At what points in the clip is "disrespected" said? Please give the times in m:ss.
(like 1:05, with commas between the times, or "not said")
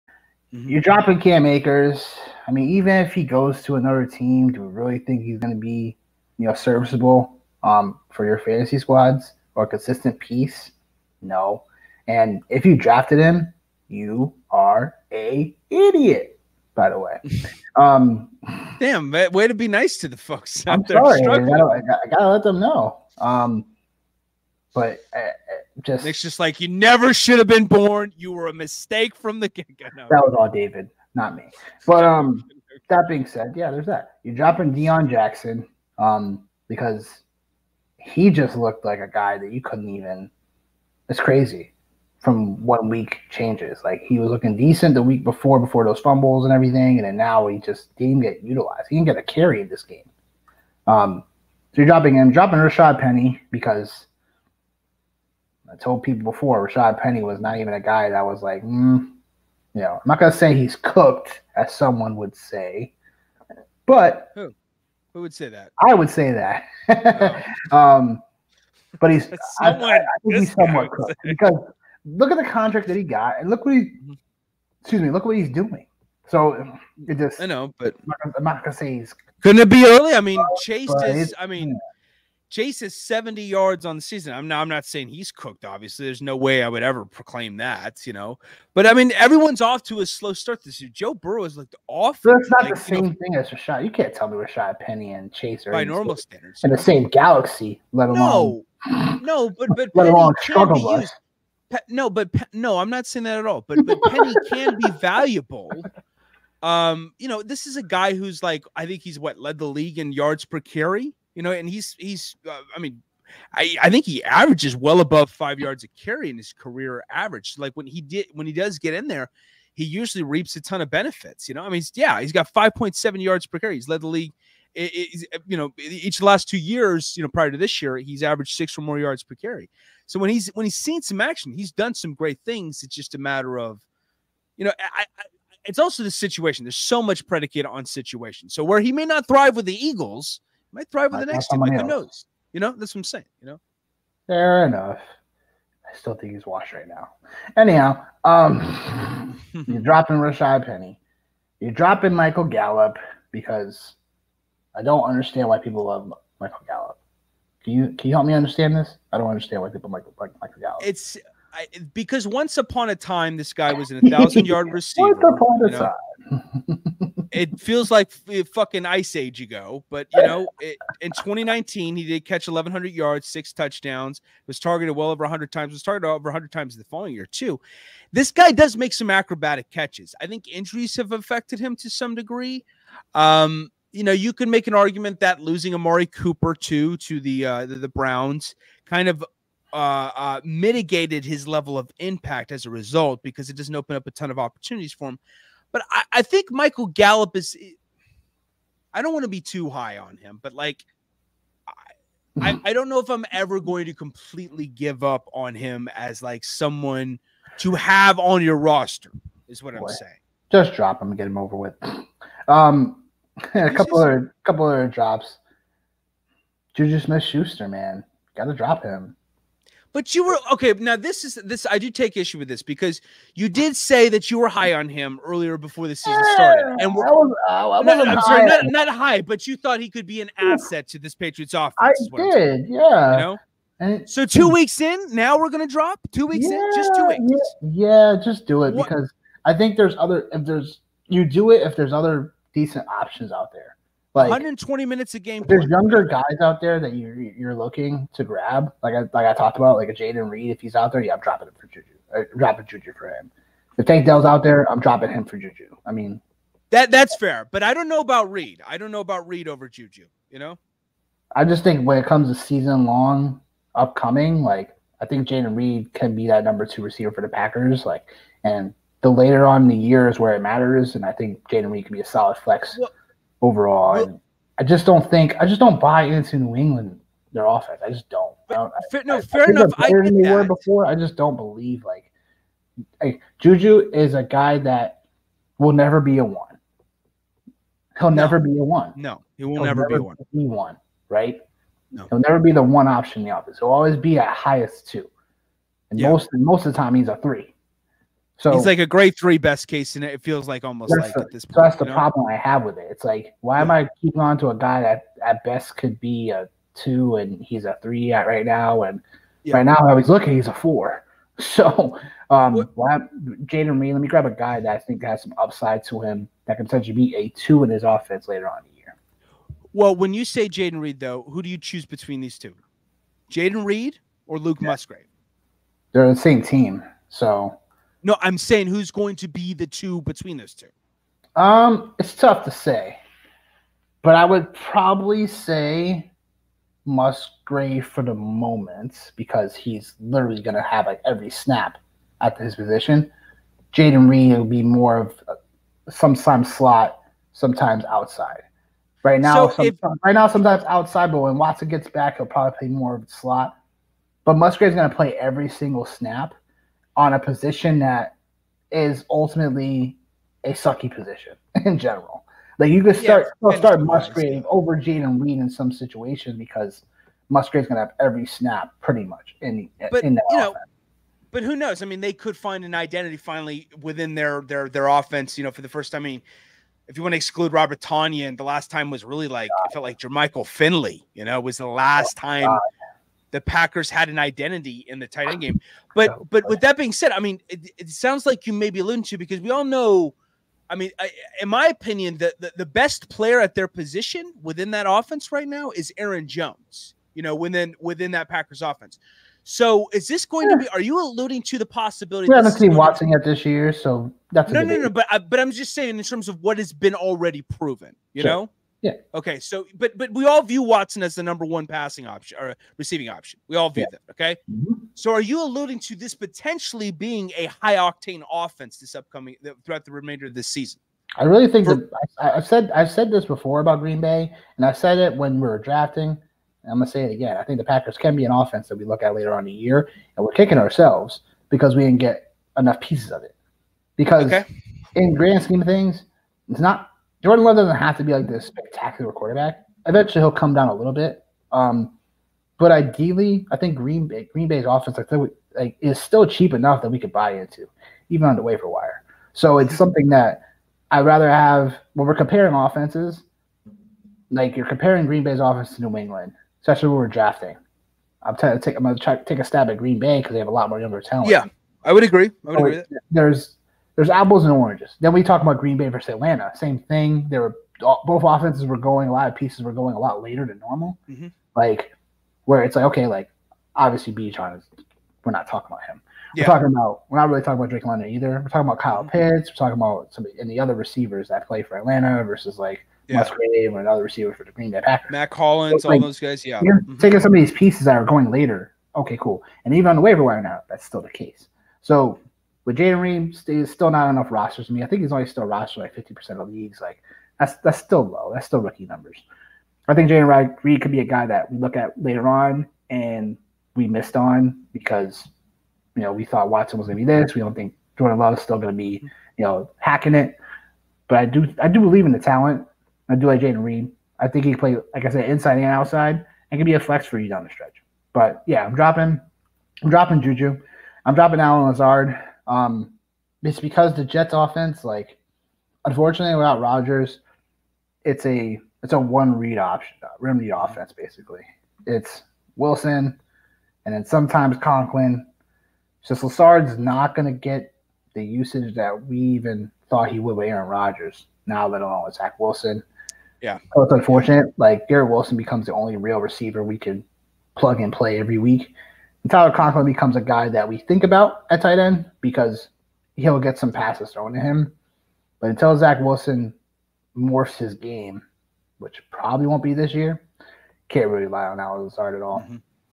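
not said.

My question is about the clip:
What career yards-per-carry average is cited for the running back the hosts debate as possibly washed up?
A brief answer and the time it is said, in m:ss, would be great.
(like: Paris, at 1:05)
5.7, at 2:02.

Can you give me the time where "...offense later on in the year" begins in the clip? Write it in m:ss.
5:17.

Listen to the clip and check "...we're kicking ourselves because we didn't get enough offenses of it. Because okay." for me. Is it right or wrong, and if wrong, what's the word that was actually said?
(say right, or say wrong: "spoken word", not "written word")
wrong: "pieces", not "offenses".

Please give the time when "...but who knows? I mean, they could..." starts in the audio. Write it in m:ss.
6:11.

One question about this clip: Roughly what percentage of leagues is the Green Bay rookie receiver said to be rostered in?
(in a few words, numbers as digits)
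50%.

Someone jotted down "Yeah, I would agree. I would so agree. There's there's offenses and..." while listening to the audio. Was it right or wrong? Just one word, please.
wrong.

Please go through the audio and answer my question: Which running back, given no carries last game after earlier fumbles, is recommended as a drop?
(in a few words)
Deon Jackson.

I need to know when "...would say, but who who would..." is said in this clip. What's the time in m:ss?
1:02.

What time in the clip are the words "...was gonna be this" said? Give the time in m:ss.
8:26.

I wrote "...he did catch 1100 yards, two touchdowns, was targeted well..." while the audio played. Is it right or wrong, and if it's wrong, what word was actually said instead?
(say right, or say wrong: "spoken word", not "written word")
wrong: "six", not "two".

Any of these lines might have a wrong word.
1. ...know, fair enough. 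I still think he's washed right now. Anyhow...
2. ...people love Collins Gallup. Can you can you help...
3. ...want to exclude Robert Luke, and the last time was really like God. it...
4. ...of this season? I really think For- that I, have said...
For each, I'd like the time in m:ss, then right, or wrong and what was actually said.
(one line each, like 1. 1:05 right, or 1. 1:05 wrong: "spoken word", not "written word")
1. 2:23 right
2. 2:35 wrong: "Michael", not "Collins"
3. 6:17 wrong: "Tonyan", not "Luke"
4. 7:00 right.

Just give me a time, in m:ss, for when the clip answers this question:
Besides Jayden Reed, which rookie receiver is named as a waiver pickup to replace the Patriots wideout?
4:13.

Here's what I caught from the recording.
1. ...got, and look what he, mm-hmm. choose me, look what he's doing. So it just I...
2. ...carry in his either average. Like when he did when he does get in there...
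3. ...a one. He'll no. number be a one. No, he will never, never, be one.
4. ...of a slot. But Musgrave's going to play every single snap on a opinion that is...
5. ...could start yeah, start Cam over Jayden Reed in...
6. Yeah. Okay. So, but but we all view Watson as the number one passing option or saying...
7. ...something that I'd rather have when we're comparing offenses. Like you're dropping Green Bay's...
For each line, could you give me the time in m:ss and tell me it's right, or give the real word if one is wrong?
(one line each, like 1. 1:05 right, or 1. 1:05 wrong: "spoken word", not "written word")
1. 1:13 wrong: "excuse", not "choose"
2. 1:55 wrong: "career", not "either"
3. 4:46 wrong: "never", not "number"
4. 5:52 wrong: "position", not "opinion"
5. 6:02 wrong: "Musgrave", not "Cam"
6. 6:48 wrong: "receiving", not "saying"
7. 7:29 wrong: "comparing", not "dropping".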